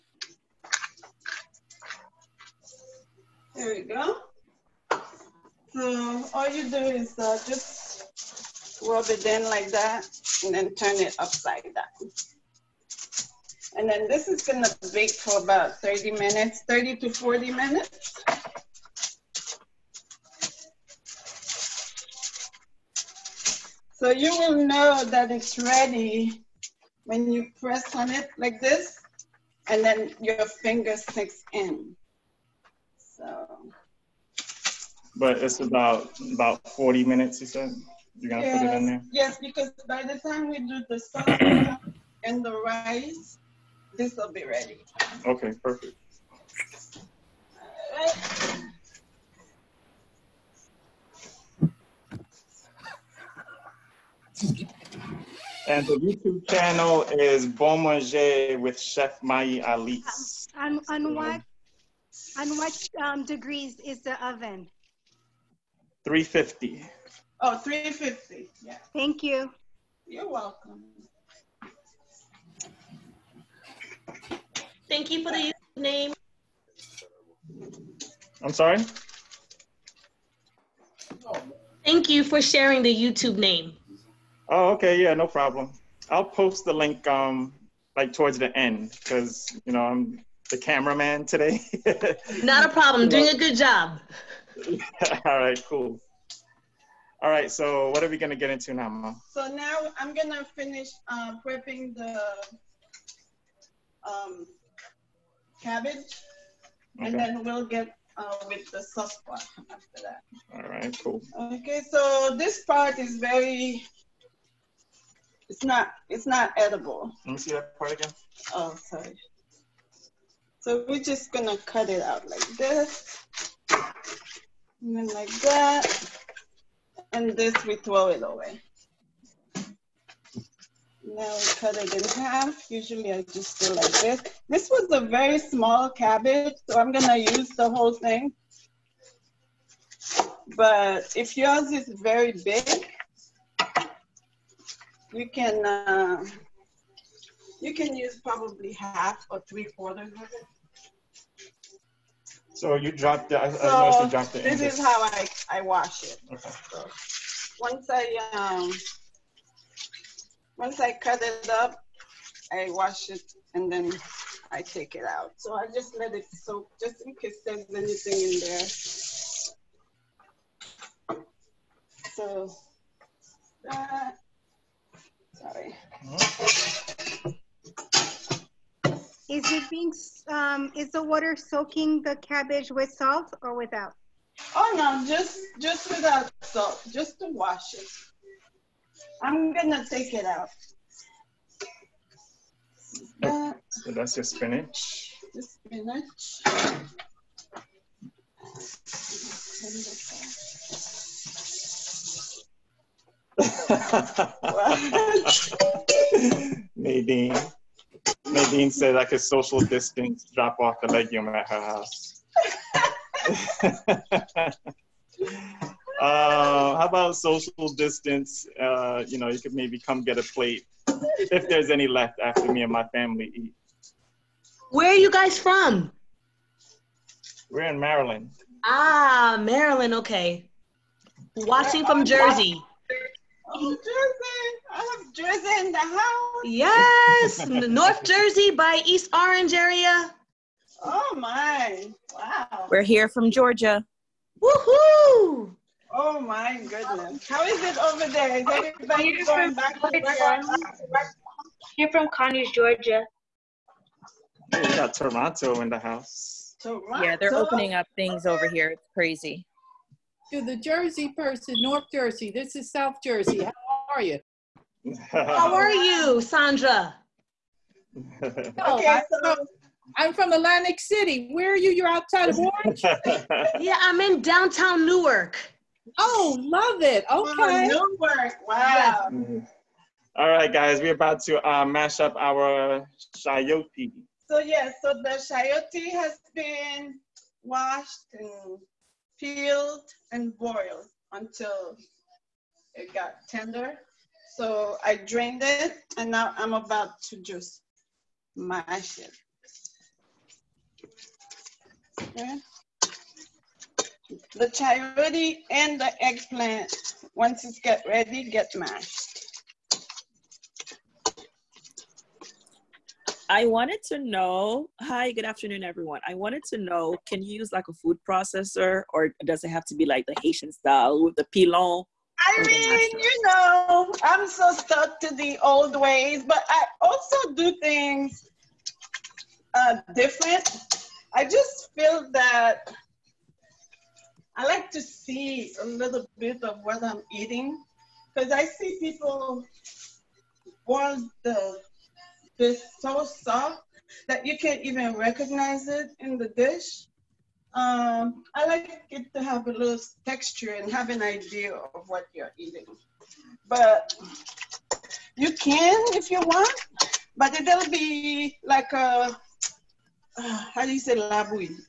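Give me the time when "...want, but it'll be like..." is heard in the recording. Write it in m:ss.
5:56.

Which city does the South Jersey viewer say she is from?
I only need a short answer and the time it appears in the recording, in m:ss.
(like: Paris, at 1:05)
Atlantic City, at 4:30.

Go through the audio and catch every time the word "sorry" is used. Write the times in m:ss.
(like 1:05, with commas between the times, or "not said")
1:18, 1:58, 2:55.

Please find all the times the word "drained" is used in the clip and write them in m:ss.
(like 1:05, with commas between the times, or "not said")
4:54.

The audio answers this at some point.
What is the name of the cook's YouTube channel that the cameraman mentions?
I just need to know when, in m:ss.
0:57.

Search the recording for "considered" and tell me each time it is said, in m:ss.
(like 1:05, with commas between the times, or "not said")
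not said.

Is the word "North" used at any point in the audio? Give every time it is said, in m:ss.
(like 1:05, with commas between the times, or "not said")
3:57, 4:21.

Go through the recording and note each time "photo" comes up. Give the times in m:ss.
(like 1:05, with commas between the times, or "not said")
not said.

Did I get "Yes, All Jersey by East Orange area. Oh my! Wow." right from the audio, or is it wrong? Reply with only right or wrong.
wrong.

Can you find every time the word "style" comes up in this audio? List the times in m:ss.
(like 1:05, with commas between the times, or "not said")
5:20.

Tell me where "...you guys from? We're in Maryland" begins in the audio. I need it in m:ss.
3:44.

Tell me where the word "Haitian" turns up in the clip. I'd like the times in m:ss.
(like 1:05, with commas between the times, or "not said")
5:20.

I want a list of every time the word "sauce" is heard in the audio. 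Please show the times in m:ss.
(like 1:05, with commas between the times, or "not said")
0:40, 1:48.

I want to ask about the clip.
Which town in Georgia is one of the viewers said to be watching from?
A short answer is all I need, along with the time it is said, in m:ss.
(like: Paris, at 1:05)
Conyers, at 4:12.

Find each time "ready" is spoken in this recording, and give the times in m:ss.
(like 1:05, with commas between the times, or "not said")
0:25, 0:44, 5:07.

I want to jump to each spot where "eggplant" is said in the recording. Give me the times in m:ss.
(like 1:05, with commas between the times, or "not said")
5:06.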